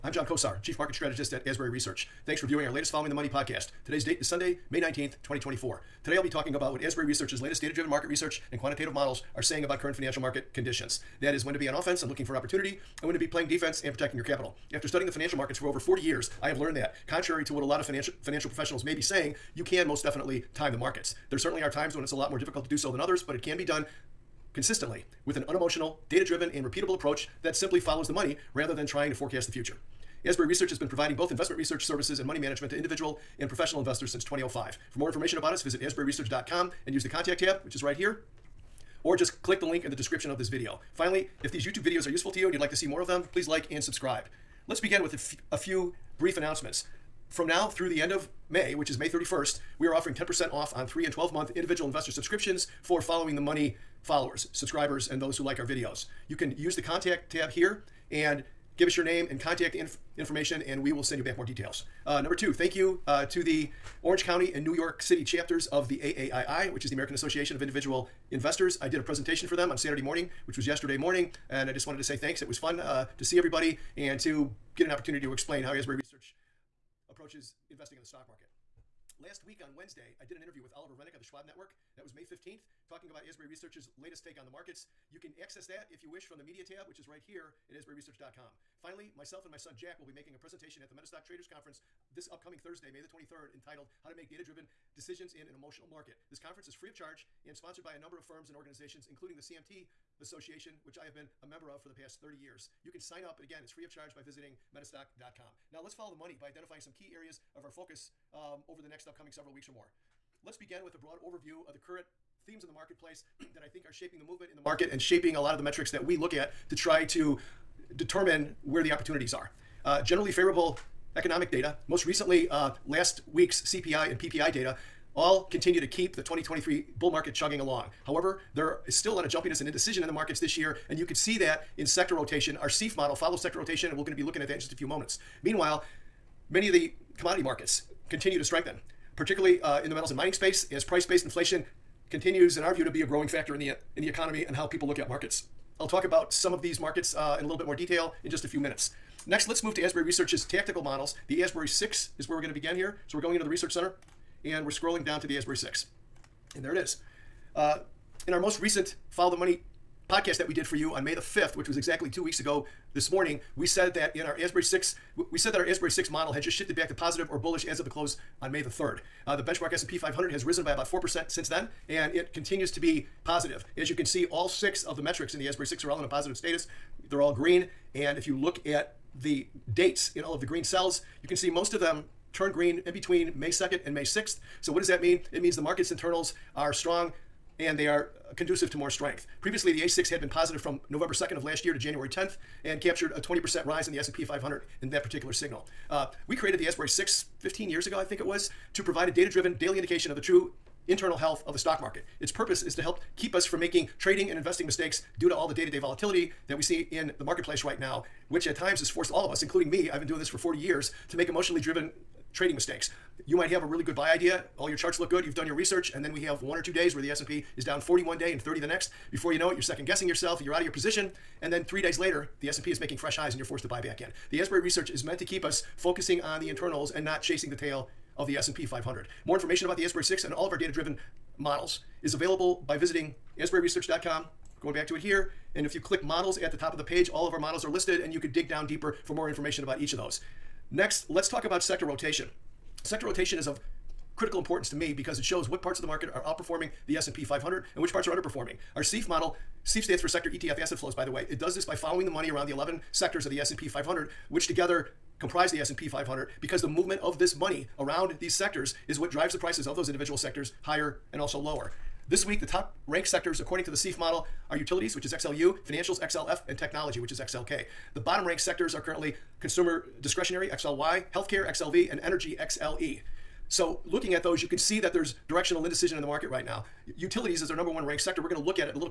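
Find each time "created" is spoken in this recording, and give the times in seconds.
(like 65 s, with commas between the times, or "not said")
196 s.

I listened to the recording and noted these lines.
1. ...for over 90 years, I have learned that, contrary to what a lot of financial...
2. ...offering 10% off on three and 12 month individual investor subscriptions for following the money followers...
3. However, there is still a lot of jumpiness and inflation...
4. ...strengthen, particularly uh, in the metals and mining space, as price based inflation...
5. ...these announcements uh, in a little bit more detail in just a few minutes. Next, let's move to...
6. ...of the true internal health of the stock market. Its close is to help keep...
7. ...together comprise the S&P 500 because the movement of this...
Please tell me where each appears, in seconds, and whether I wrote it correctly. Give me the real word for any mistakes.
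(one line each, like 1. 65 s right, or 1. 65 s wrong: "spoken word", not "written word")
1. 15 s wrong: "40", not "90"
2. 49 s right
3. 128 s wrong: "indecision", not "inflation"
4. 138 s right
5. 146 s wrong: "markets", not "announcements"
6. 200 s wrong: "purpose", not "close"
7. 254 s right.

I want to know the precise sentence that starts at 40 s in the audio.
Finally, if these YouTube videos are useful to you and you'd like to see more of them, please like and subscribe.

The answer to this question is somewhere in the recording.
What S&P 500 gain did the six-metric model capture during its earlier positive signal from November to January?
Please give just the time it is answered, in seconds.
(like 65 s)
193 s.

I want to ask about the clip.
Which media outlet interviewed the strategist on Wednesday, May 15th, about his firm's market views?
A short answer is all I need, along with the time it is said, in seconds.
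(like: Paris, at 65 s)
Schwab Network, at 81 s.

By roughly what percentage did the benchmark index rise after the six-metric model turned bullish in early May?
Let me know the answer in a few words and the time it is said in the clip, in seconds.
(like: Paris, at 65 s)
4%, at 170 s.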